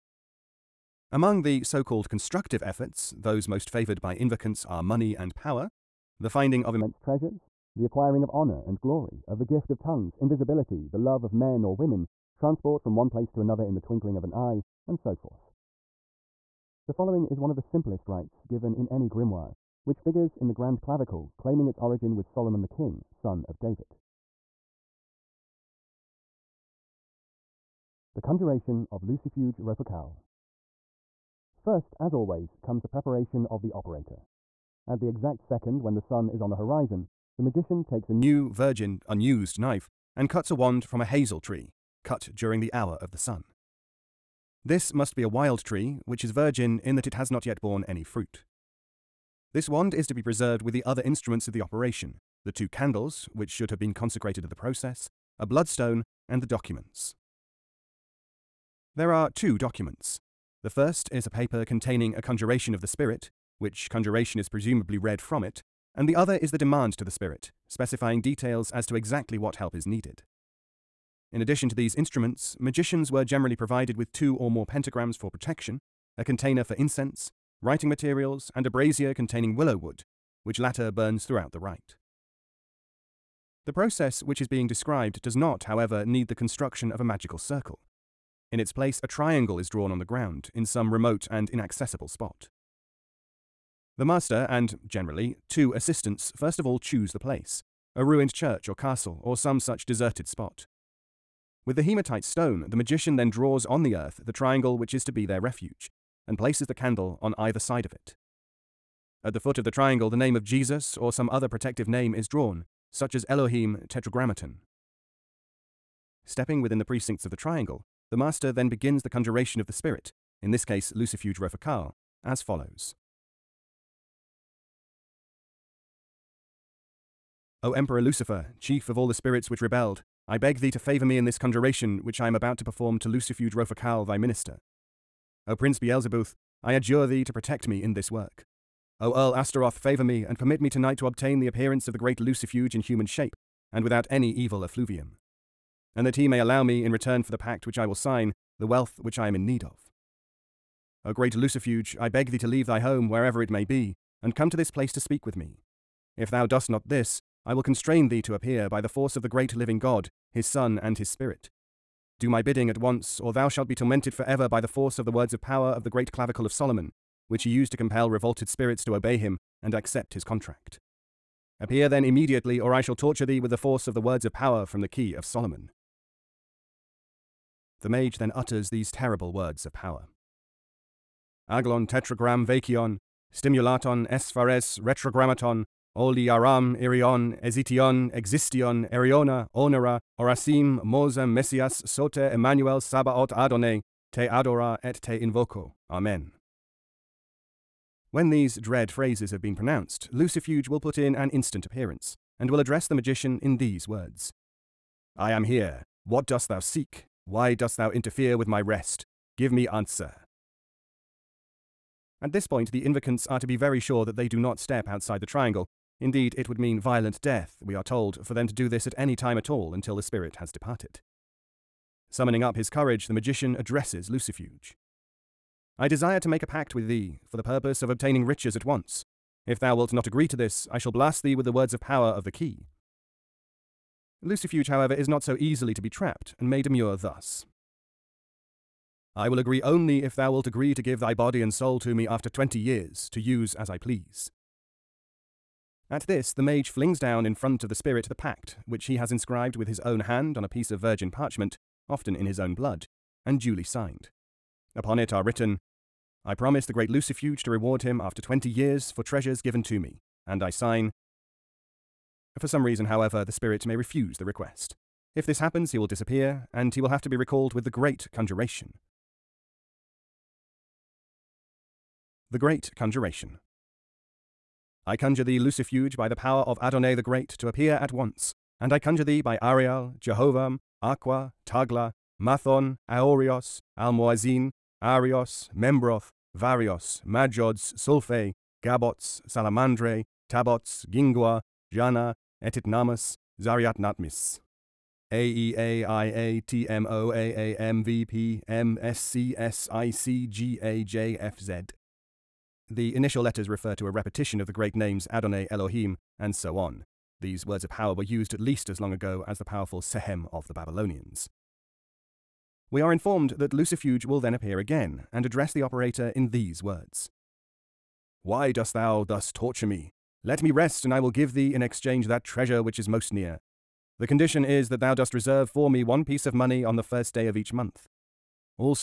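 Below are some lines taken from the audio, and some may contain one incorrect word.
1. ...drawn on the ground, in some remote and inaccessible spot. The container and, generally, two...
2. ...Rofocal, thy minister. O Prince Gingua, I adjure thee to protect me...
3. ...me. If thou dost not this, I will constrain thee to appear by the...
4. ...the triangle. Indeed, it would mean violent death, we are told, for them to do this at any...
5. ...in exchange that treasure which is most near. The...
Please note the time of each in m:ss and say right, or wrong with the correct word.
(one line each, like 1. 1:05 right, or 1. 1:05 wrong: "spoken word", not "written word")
1. 1:29 wrong: "master", not "container"
2. 2:13 wrong: "Beelzebuth", not "Gingua"
3. 2:35 right
4. 3:35 right
5. 5:21 right.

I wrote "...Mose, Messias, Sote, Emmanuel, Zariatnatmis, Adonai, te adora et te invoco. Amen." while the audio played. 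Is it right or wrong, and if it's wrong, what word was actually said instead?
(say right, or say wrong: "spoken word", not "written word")
wrong: "Sabaoth", not "Zariatnatmis".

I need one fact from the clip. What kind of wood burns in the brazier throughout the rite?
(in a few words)
Willow.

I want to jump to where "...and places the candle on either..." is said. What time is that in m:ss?
1:46.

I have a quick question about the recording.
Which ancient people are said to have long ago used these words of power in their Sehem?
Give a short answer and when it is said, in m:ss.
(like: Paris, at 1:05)
Babylonians, at 5:10.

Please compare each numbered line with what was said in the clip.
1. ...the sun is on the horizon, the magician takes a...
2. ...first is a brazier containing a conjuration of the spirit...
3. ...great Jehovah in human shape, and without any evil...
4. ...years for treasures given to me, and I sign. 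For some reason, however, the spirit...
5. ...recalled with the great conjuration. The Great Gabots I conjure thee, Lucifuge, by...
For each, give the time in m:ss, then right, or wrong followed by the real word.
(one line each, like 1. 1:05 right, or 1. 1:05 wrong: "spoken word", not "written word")
1. 0:35 right
2. 1:00 wrong: "paper", not "brazier"
3. 2:21 wrong: "Lucifuge", not "Jehovah"
4. 4:18 right
5. 4:27 wrong: "Conjuration", not "Gabots".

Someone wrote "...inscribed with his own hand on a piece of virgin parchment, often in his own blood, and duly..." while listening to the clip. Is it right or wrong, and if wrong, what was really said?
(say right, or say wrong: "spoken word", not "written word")
right.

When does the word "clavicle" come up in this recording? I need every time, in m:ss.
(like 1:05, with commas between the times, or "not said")
0:20, 2:46.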